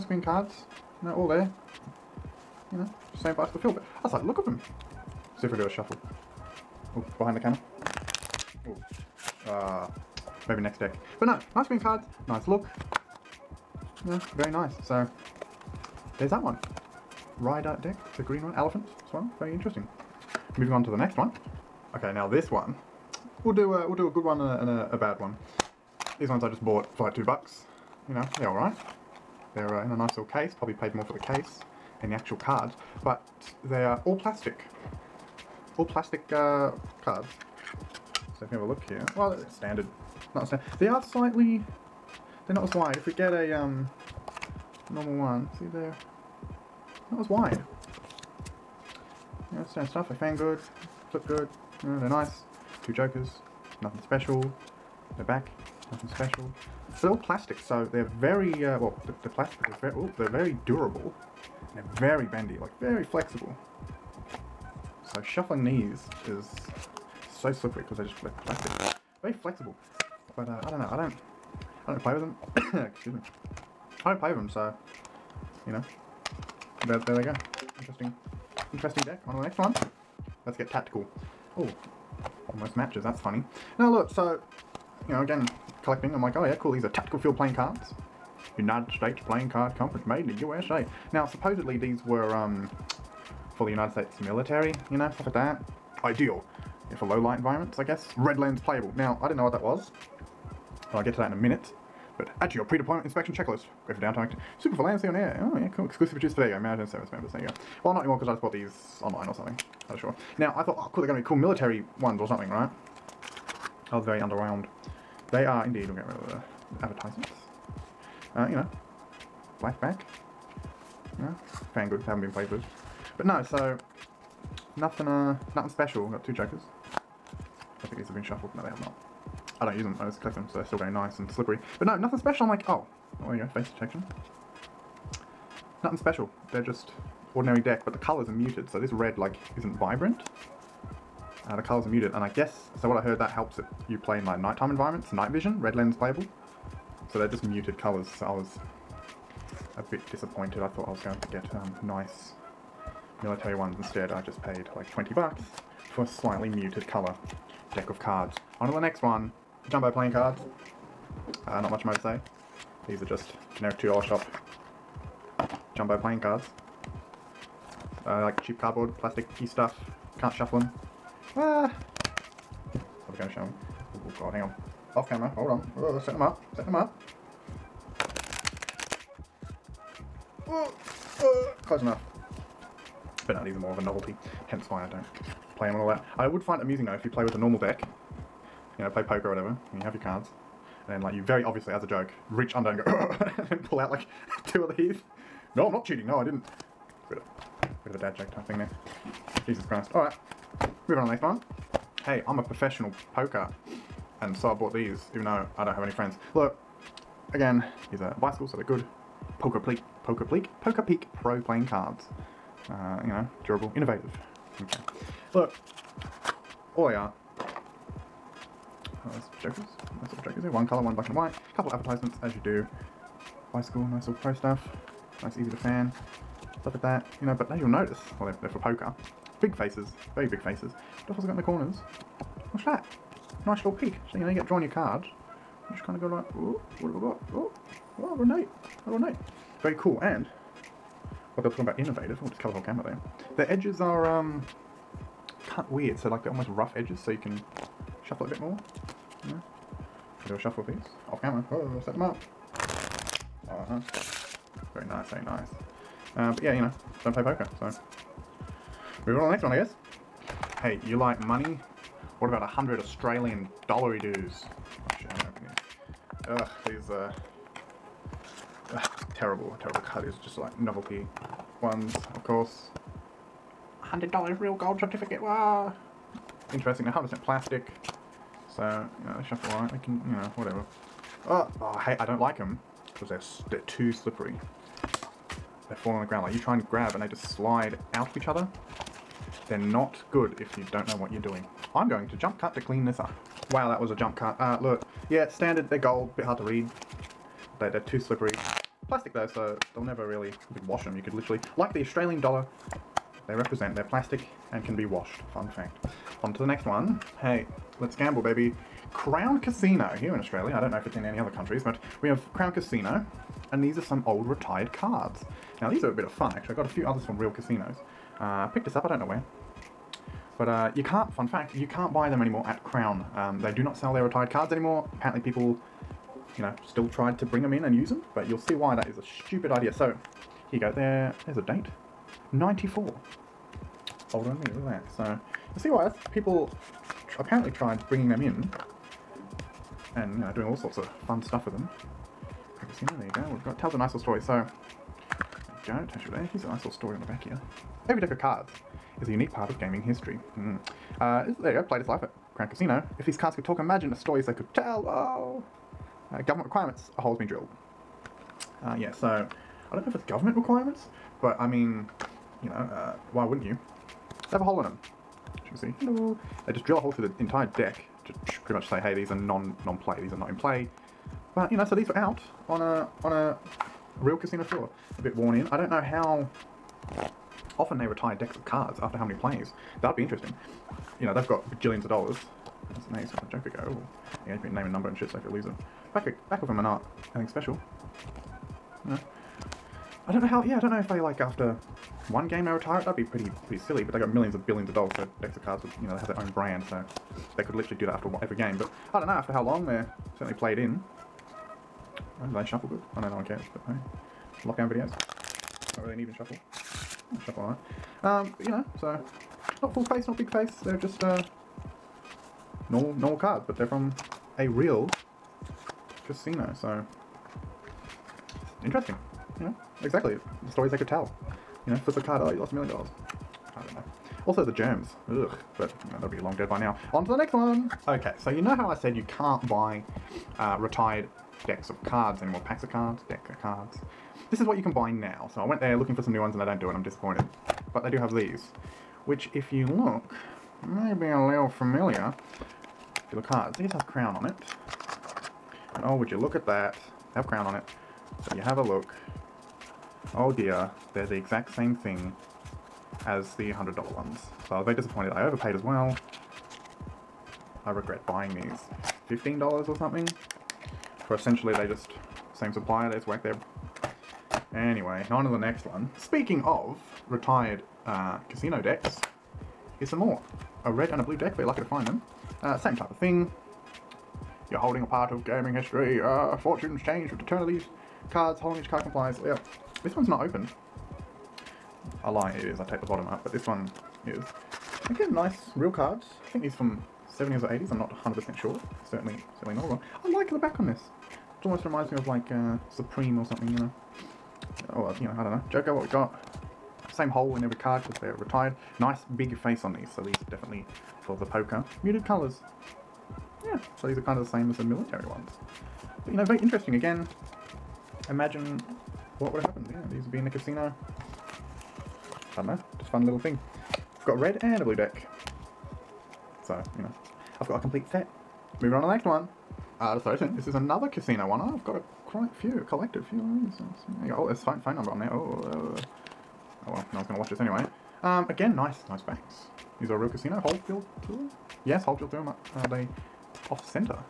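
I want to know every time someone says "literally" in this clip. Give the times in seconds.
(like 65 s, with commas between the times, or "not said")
301 s, 397 s.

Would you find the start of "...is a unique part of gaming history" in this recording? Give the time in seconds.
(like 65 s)
349 s.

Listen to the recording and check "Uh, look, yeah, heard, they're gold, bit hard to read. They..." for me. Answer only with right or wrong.
wrong.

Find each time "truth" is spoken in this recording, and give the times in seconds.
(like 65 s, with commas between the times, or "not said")
not said.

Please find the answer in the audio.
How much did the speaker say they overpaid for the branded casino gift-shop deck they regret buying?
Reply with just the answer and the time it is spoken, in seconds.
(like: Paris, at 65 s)
$15, at 459 s.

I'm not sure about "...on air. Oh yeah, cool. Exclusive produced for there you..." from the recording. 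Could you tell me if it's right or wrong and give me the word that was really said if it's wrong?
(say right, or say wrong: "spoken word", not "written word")
right.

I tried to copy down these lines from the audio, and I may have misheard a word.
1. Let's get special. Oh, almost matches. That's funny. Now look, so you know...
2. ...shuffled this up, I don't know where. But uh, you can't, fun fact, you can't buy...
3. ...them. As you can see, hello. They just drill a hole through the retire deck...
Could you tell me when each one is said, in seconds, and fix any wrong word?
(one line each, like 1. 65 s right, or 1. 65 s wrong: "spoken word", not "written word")
1. 80 s wrong: "tactical", not "special"
2. 318 s wrong: "picked", not "shuffled"
3. 364 s wrong: "entire", not "retire".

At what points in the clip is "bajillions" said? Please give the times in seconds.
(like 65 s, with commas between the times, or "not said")
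381 s.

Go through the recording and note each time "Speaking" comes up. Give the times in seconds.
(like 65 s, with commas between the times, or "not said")
465 s.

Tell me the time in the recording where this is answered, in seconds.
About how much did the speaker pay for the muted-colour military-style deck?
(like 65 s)
154 s.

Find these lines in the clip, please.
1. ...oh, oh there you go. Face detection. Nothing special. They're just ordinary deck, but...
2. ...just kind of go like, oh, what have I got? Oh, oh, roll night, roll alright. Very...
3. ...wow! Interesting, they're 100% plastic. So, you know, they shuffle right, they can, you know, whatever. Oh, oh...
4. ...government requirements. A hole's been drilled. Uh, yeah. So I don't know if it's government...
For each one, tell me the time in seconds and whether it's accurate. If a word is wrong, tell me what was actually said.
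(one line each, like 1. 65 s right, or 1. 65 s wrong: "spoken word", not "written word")
1. 132 s right
2. 235 s wrong: "night", not "alright"
3. 275 s right
4. 356 s right.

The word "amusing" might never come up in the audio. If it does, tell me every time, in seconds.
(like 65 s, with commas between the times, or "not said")
186 s.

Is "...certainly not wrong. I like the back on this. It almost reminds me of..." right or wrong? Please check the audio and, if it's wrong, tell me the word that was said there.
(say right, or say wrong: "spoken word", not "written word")
right.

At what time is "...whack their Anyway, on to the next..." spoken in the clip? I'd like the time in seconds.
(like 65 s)
463 s.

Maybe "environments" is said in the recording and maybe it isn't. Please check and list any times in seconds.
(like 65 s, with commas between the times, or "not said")
97 s, 144 s.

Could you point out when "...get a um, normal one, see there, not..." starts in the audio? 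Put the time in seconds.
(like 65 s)
43 s.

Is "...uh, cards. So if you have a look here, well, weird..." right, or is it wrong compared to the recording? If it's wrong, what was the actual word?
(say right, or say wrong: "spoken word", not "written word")
wrong: "standard", not "weird".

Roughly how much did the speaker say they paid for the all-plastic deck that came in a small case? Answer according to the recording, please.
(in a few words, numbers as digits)
2 bucks.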